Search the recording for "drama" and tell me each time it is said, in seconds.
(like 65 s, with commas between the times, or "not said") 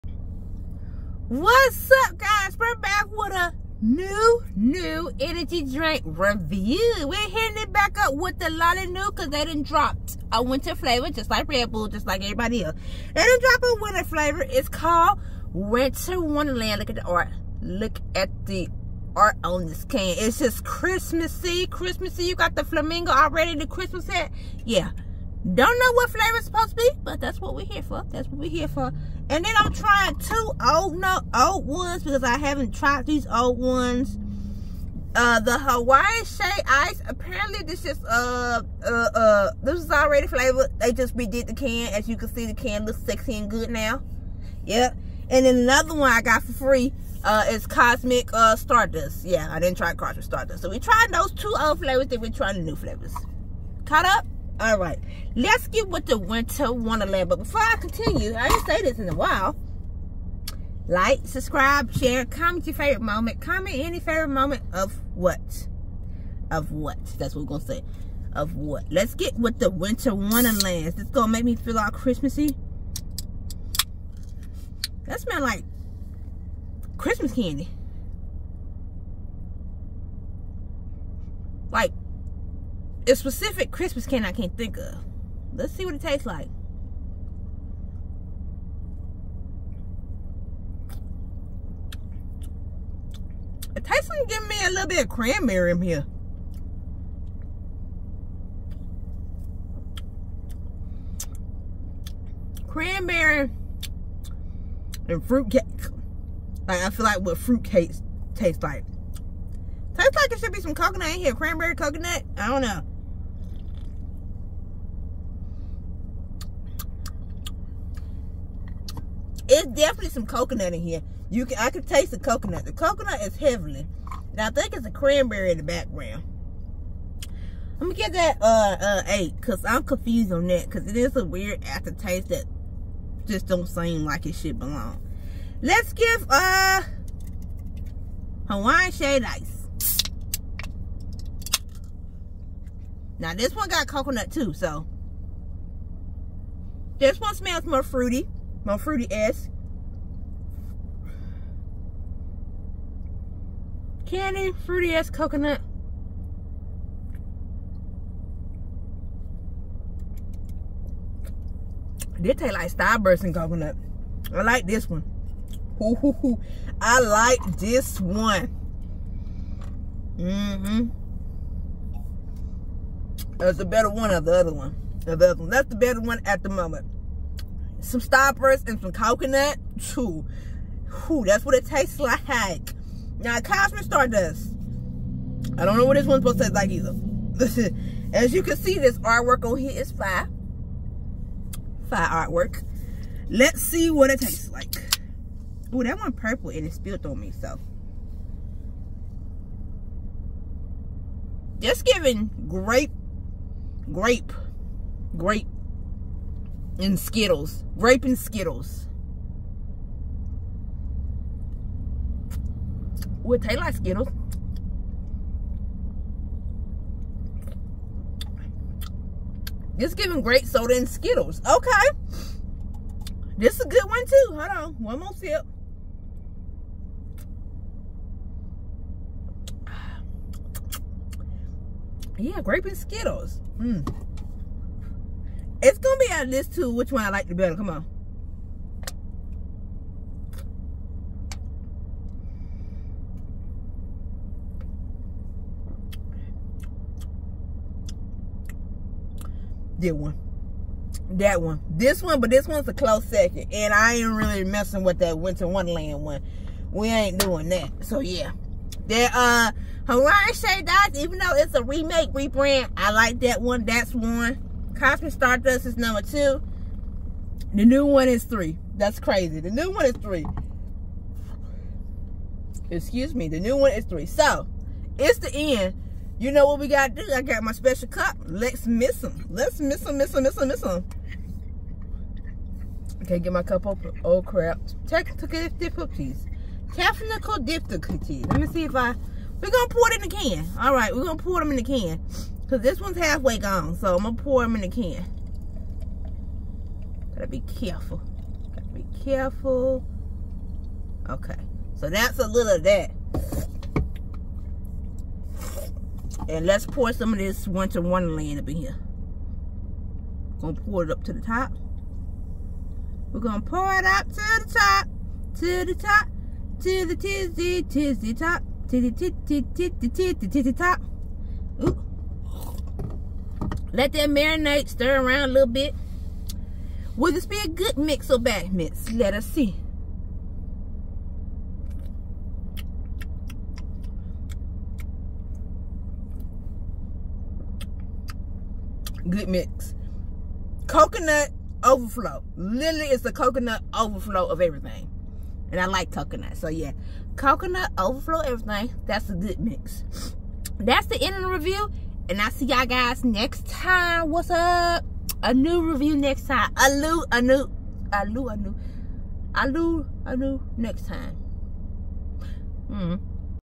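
not said.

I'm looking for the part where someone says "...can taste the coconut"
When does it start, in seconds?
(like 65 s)
121 s.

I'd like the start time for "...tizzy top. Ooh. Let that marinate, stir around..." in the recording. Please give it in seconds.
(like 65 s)
320 s.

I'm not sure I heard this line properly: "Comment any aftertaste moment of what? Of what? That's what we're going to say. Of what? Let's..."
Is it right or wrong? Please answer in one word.
wrong.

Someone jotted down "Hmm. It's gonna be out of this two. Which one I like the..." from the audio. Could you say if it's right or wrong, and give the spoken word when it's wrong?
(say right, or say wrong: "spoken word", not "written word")
right.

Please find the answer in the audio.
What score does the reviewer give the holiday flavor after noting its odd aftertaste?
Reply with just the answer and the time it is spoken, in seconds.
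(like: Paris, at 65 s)
8, at 129 s.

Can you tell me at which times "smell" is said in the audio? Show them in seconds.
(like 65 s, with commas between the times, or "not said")
75 s, 147 s.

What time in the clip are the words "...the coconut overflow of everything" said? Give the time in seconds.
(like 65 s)
343 s.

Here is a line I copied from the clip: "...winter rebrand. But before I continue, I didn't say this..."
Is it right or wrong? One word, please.
wrong.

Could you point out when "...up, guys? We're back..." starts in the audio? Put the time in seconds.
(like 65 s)
2 s.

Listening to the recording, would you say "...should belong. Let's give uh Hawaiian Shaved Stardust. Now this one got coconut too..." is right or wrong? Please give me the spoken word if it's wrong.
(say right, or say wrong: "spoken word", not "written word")
wrong: "Ice", not "Stardust".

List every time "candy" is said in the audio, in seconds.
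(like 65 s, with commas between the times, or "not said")
77 s, 84 s, 154 s.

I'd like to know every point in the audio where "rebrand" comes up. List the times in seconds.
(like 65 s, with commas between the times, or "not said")
262 s.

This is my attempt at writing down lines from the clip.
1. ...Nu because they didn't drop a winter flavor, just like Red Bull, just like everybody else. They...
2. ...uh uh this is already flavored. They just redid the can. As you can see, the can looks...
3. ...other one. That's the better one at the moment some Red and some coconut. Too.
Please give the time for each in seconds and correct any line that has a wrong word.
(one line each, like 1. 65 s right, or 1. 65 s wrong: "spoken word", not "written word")
1. 8 s right
2. 38 s right
3. 175 s wrong: "Starburst", not "Red".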